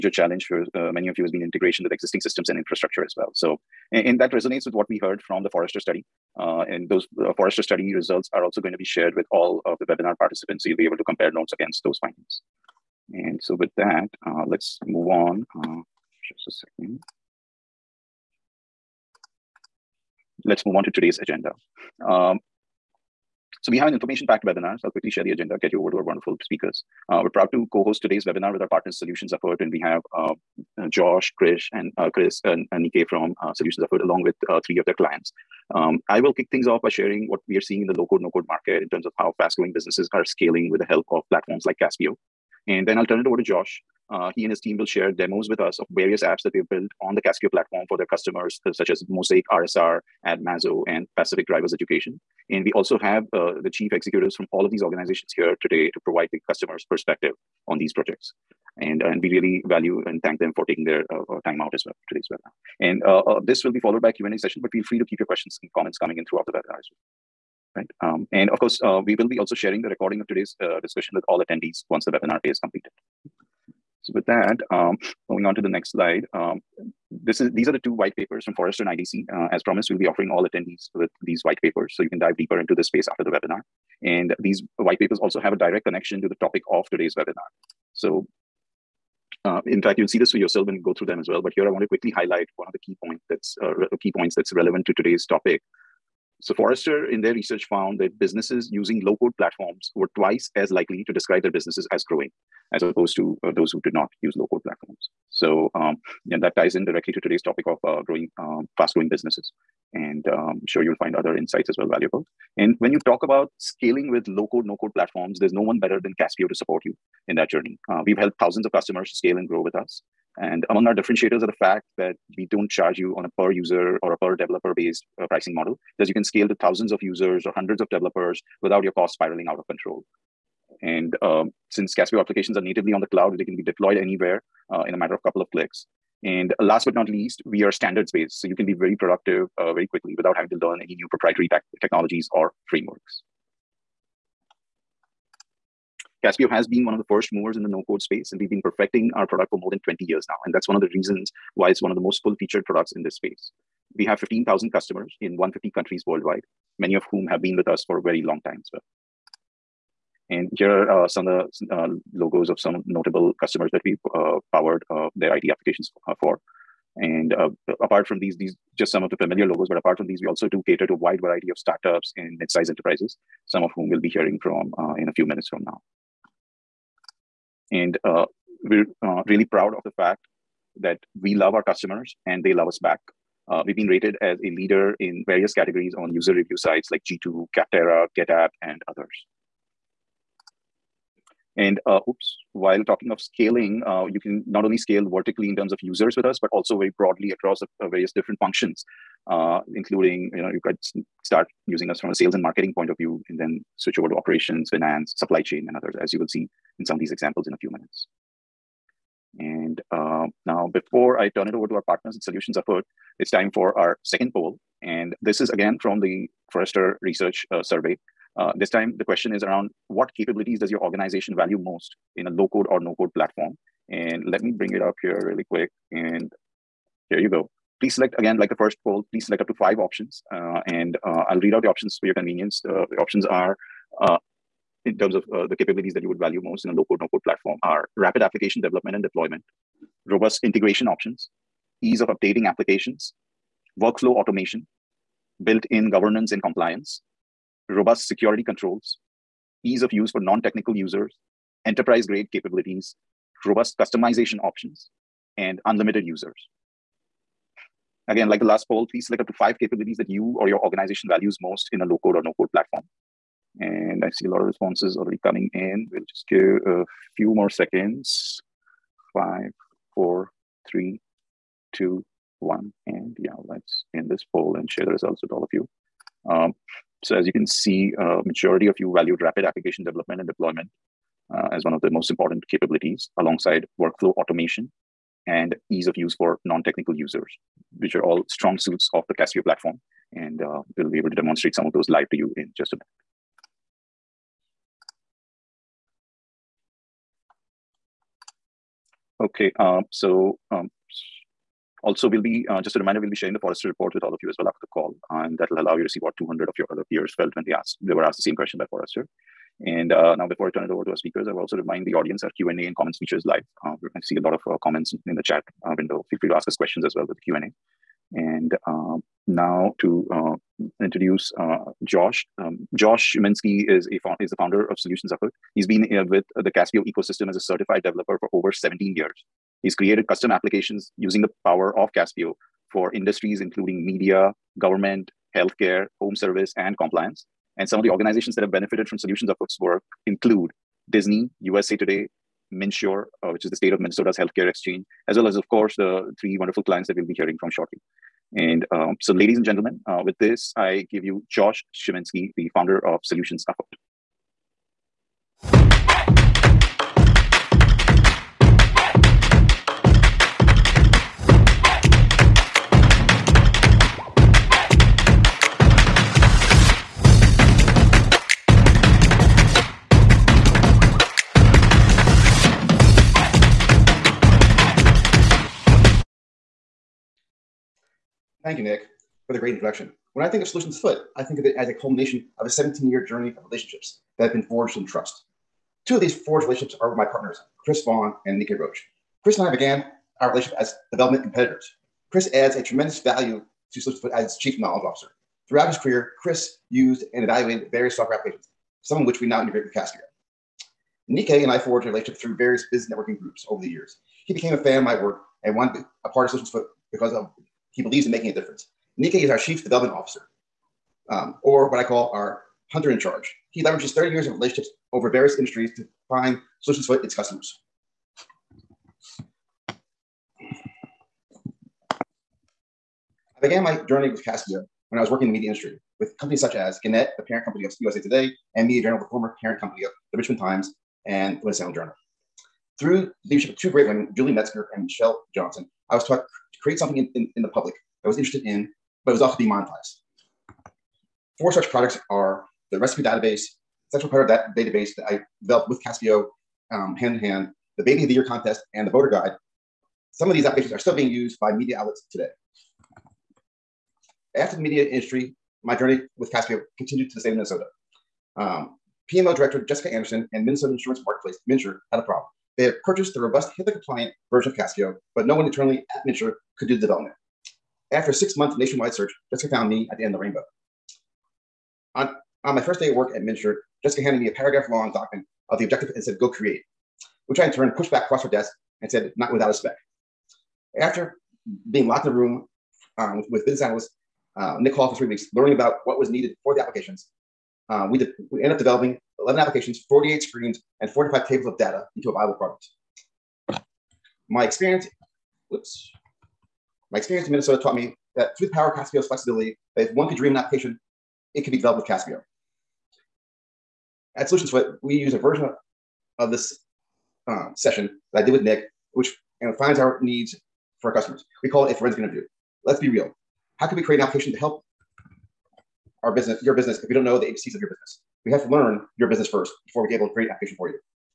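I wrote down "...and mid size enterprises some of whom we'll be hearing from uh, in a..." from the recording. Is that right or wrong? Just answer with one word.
right.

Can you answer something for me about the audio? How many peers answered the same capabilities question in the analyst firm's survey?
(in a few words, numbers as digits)
200.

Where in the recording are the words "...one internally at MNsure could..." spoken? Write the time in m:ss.
7:45.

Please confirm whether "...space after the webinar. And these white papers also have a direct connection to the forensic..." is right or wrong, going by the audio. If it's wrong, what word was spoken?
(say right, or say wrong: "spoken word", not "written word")
wrong: "topic", not "forensic".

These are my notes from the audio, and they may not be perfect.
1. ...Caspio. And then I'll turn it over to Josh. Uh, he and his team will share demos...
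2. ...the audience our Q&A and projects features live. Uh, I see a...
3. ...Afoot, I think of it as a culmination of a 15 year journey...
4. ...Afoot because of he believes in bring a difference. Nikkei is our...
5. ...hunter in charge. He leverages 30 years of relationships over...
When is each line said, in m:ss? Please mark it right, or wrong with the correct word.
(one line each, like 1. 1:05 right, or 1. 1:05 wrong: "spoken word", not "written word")
1. 0:41 right
2. 5:11 wrong: "comments", not "projects"
3. 6:20 wrong: "17", not "15"
4. 6:46 wrong: "making", not "bring"
5. 6:52 right.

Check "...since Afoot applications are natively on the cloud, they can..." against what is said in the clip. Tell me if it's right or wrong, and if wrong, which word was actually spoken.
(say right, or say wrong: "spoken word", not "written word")
wrong: "Caspio", not "Afoot".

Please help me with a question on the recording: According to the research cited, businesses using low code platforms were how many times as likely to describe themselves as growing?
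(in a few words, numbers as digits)
twice.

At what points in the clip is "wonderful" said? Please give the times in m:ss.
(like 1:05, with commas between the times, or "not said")
0:26, 5:46.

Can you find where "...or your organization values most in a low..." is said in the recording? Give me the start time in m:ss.
4:20.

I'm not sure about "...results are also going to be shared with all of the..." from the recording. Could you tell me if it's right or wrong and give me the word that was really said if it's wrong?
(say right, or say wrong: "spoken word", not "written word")
right.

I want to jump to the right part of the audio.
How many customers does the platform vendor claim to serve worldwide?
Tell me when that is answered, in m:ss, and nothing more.
2:34.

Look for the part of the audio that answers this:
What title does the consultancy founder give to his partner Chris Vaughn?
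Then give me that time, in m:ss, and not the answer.
6:34.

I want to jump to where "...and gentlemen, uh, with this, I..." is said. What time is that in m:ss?
5:49.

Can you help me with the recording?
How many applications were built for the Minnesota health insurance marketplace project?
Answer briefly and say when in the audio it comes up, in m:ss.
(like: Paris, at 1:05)
11, at 8:09.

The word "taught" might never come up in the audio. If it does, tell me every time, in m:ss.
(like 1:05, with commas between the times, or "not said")
7:16, 8:17.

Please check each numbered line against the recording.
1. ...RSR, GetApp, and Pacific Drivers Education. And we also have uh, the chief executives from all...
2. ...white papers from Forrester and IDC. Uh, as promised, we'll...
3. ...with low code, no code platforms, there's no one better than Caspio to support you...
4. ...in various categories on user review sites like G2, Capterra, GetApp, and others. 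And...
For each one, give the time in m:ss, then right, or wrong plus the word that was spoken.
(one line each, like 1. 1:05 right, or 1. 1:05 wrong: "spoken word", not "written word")
1. 0:49 wrong: "AdMazo", not "GetApp"
2. 1:18 right
3. 1:54 right
4. 3:05 right.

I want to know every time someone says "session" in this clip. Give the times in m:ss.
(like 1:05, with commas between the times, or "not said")
1:04, 8:27.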